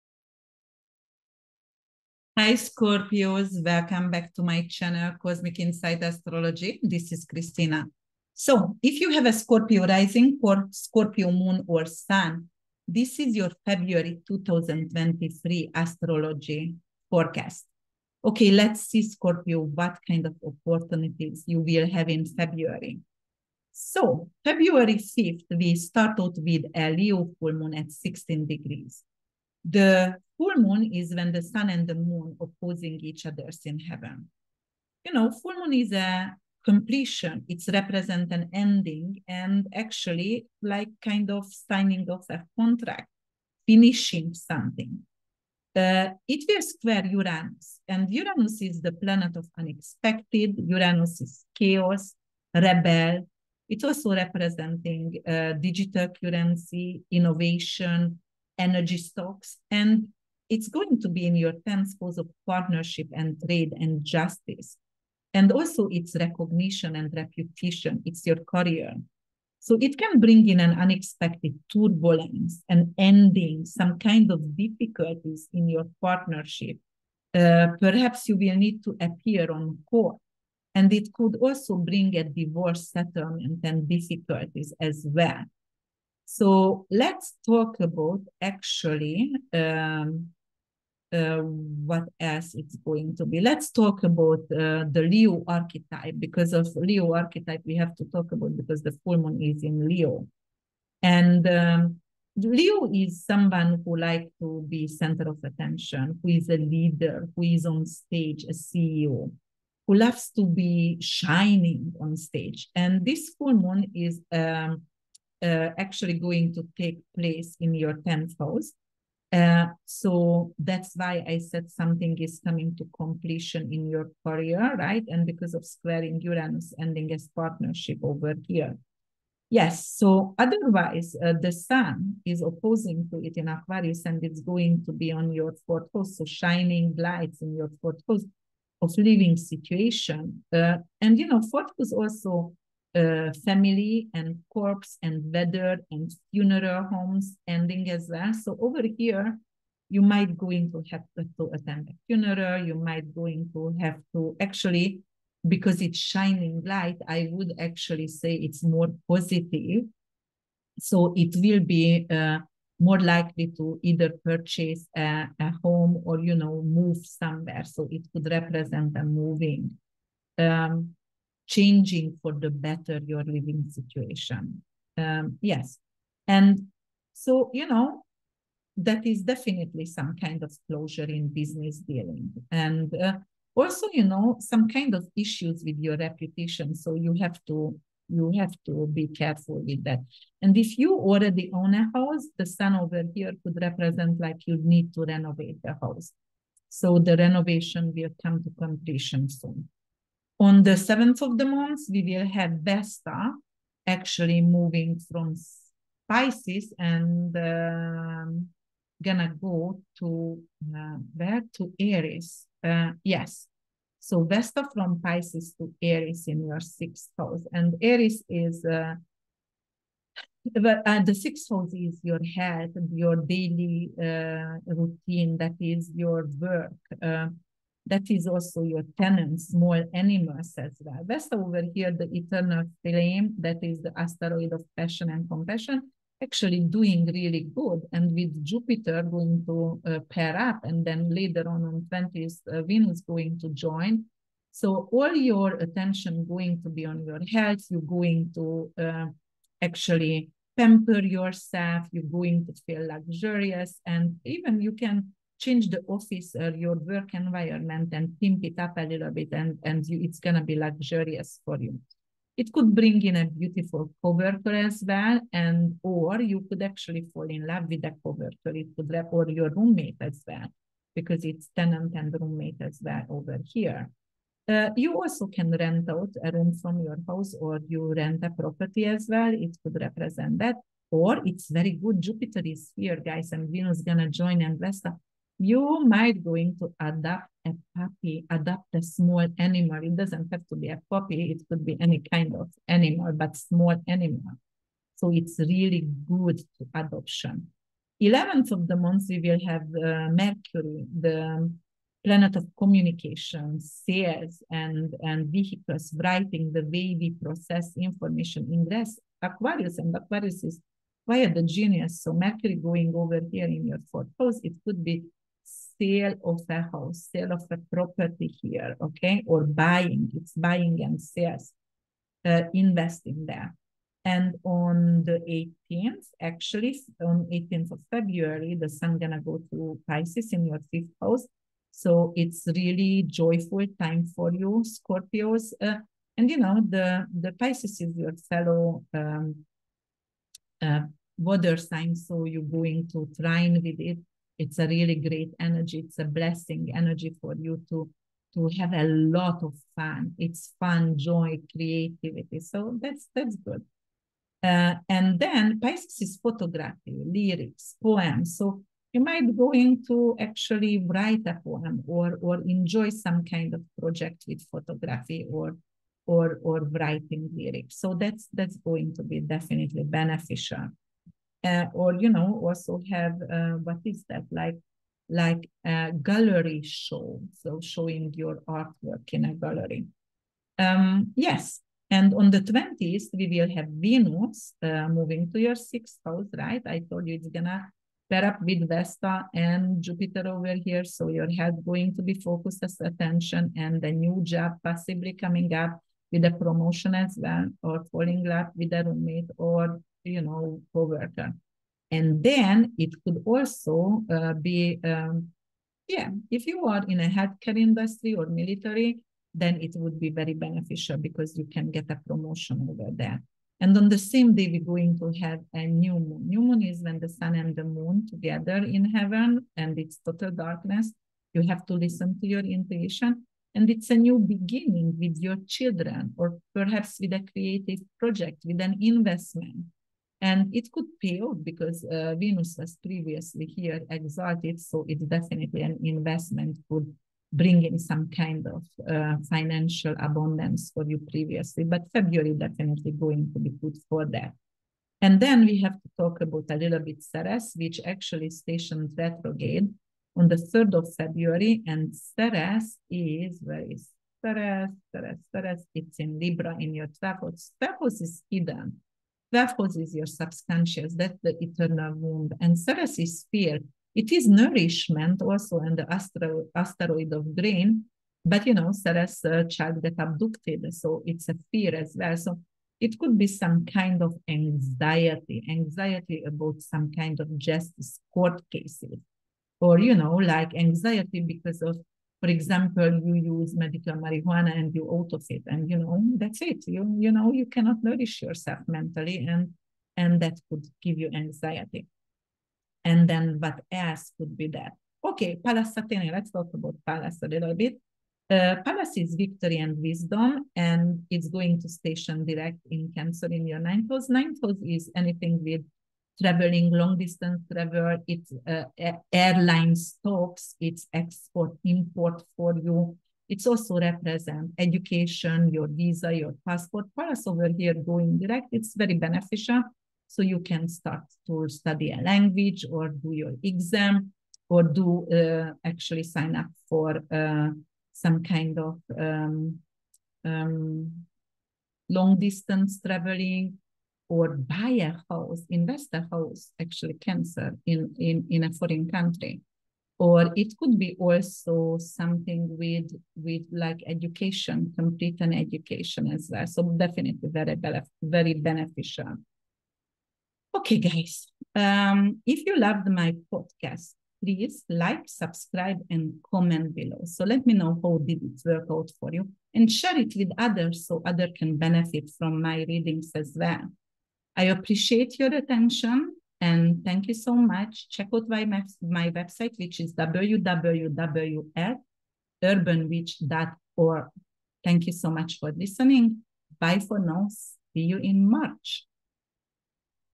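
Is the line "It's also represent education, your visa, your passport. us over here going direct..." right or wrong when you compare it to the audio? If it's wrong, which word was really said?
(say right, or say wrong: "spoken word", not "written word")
right.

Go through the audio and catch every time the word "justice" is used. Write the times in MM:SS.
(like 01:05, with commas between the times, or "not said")
01:04, 07:57.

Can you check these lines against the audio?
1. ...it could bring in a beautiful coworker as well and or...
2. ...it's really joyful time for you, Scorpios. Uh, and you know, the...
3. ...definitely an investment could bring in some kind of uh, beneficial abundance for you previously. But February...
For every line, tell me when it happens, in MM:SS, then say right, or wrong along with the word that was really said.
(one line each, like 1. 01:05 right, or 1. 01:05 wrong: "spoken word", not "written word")
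1. 04:22 right
2. 05:32 right
3. 07:15 wrong: "financial", not "beneficial".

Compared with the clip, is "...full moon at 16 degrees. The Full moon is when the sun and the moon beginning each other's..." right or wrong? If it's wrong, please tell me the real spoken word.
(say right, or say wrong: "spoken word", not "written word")
wrong: "opposing", not "beginning".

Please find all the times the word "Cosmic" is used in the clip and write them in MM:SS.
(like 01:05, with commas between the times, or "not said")
00:05.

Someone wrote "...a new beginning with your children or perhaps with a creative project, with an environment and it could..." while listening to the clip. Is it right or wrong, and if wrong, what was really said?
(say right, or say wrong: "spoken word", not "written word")
wrong: "investment", not "environment".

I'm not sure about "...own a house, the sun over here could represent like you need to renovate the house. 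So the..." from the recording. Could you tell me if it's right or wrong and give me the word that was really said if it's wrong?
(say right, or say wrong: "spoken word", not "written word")
right.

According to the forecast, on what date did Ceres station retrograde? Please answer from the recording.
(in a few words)
February 3.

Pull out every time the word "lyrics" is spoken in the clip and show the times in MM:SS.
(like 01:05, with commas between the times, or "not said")
05:57, 06:07.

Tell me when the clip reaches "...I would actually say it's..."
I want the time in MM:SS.
02:37.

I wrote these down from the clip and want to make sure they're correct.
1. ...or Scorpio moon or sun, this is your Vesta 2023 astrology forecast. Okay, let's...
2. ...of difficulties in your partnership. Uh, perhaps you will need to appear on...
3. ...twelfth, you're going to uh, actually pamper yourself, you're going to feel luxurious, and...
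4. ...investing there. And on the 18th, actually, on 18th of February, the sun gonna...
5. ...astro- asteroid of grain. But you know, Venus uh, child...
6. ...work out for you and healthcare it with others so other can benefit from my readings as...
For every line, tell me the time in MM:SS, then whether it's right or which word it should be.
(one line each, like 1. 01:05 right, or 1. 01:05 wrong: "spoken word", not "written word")
1. 00:10 wrong: "February", not "Vesta"
2. 01:14 right
3. 04:07 wrong: "health", not "twelfth"
4. 05:22 right
5. 07:45 wrong: "Ceres", not "Venus"
6. 09:18 wrong: "share", not "healthcare".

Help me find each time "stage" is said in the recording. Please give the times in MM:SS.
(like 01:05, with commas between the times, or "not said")
01:47, 01:52.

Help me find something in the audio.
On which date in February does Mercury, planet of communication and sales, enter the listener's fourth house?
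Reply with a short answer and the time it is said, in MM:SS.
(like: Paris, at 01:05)
11th, at 04:58.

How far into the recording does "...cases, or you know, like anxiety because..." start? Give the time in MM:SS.
07:58.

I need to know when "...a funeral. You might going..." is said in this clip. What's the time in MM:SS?
02:31.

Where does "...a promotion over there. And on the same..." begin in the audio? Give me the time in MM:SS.
06:51.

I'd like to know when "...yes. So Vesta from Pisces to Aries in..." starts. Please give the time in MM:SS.
03:33.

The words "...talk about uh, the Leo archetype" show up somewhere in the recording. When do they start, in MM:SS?
01:33.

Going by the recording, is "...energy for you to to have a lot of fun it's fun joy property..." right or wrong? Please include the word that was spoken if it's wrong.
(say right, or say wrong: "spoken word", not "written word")
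wrong: "creativity", not "property".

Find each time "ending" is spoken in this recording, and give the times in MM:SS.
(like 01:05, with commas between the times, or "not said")
00:38, 01:12, 02:06, 02:27.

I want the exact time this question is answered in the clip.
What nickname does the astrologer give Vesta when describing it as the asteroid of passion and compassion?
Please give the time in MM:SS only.
03:51.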